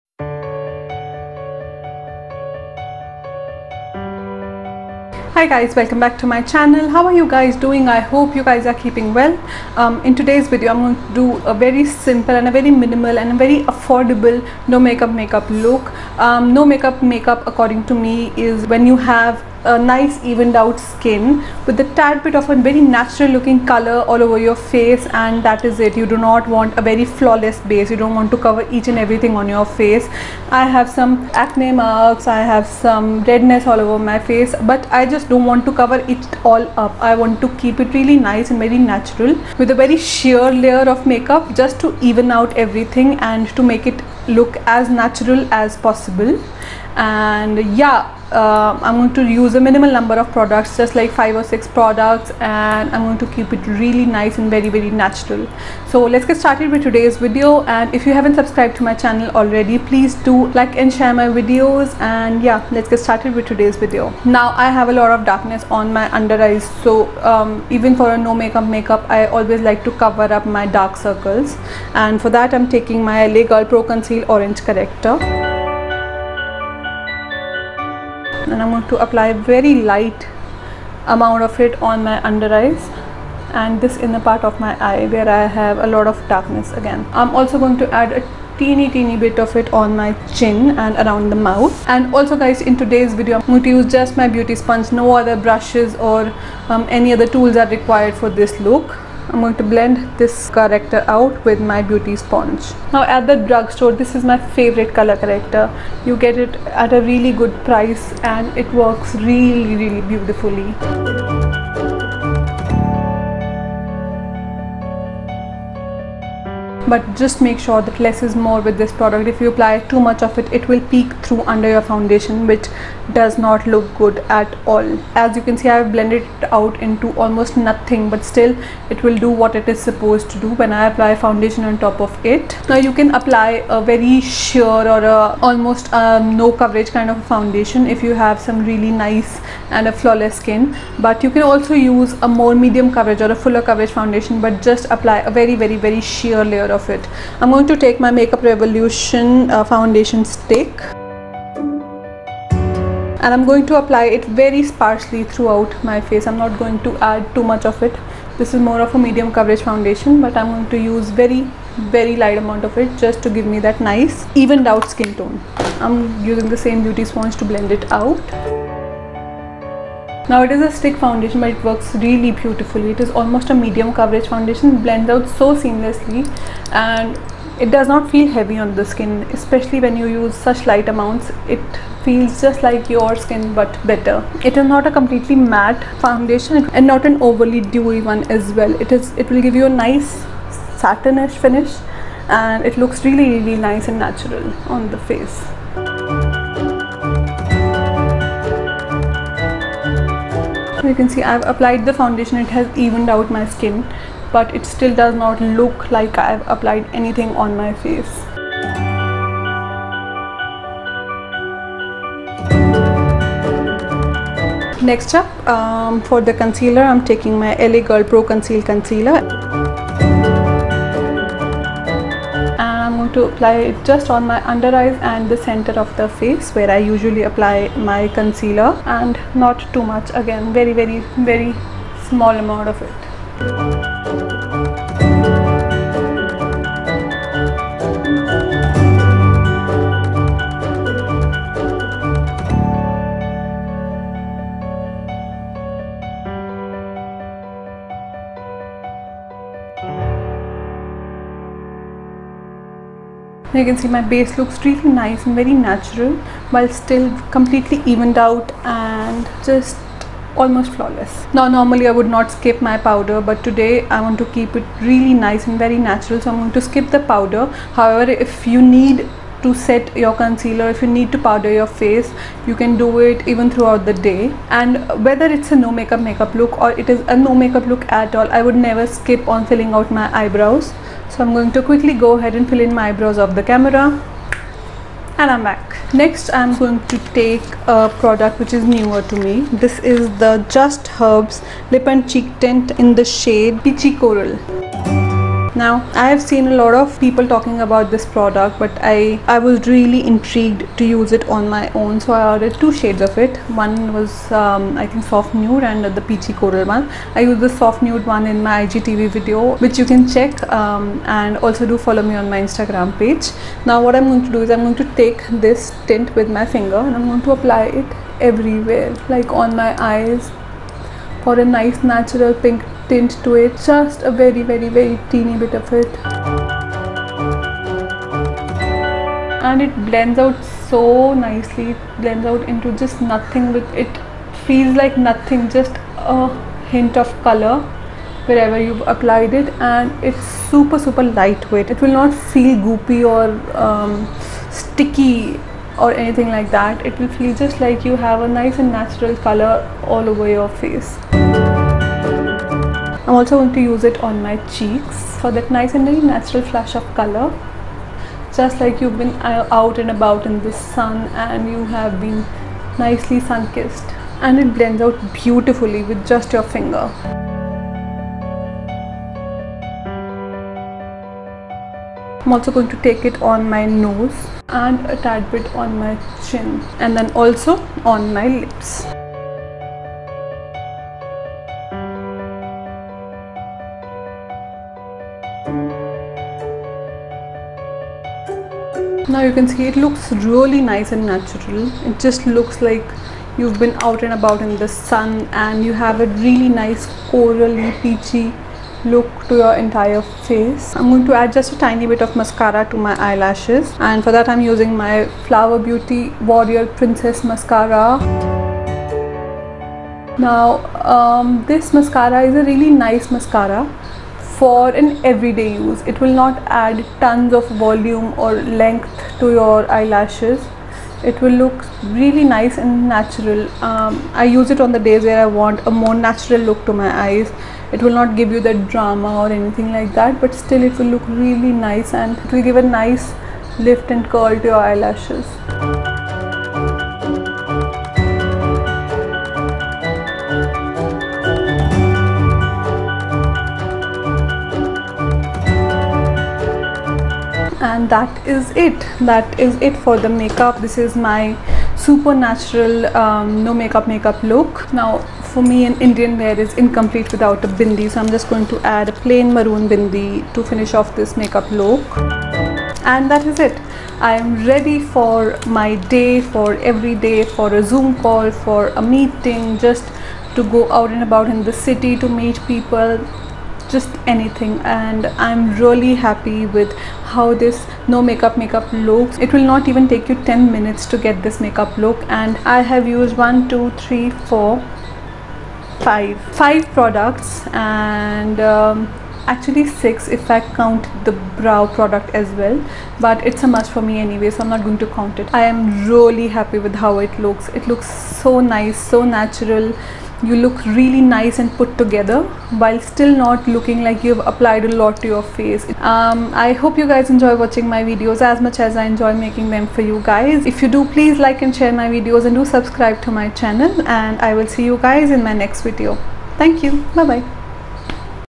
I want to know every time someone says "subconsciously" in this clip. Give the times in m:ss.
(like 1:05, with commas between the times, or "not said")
not said.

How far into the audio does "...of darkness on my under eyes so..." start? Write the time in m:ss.
1:05.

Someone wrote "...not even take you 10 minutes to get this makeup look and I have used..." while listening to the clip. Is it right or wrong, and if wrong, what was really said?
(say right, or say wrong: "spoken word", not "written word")
right.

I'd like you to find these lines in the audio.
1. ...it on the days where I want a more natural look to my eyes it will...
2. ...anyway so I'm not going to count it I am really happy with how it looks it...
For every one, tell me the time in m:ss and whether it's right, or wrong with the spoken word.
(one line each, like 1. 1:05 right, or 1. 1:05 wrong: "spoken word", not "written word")
1. 7:04 right
2. 8:13 right.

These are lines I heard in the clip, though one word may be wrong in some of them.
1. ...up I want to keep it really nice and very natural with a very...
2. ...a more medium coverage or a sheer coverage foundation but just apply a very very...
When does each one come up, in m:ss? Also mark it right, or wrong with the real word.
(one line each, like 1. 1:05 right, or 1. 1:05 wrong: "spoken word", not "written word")
1. 0:36 right
2. 2:22 wrong: "fuller", not "sheer".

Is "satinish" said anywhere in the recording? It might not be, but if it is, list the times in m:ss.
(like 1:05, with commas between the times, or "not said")
3:10.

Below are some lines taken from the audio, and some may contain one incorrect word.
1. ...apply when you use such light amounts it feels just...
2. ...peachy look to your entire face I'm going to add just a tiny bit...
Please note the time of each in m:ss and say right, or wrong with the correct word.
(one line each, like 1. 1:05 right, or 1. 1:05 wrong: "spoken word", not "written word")
1. 2:59 wrong: "especially", not "apply"
2. 6:37 right.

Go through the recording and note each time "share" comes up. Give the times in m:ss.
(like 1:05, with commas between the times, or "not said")
1:00, 8:31.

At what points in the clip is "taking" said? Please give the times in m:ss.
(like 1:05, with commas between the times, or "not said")
1:12, 3:37.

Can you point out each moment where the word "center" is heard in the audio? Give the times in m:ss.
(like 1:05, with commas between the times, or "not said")
3:45.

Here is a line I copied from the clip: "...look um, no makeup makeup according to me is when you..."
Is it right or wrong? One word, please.
right.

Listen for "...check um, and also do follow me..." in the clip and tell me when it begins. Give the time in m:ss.
5:10.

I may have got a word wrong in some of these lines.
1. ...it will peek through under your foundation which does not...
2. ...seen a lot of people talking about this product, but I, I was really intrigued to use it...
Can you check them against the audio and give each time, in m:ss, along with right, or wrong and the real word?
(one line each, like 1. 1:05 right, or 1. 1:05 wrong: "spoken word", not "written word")
1. 2:00 right
2. 4:56 right.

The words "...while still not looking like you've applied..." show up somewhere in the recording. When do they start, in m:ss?
8:22.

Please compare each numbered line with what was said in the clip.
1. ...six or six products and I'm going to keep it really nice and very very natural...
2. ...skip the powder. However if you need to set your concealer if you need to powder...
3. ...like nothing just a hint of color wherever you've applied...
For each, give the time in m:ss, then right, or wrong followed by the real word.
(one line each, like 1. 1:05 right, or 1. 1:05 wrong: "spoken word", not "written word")
1. 0:51 wrong: "five", not "six"
2. 4:26 right
3. 5:34 right.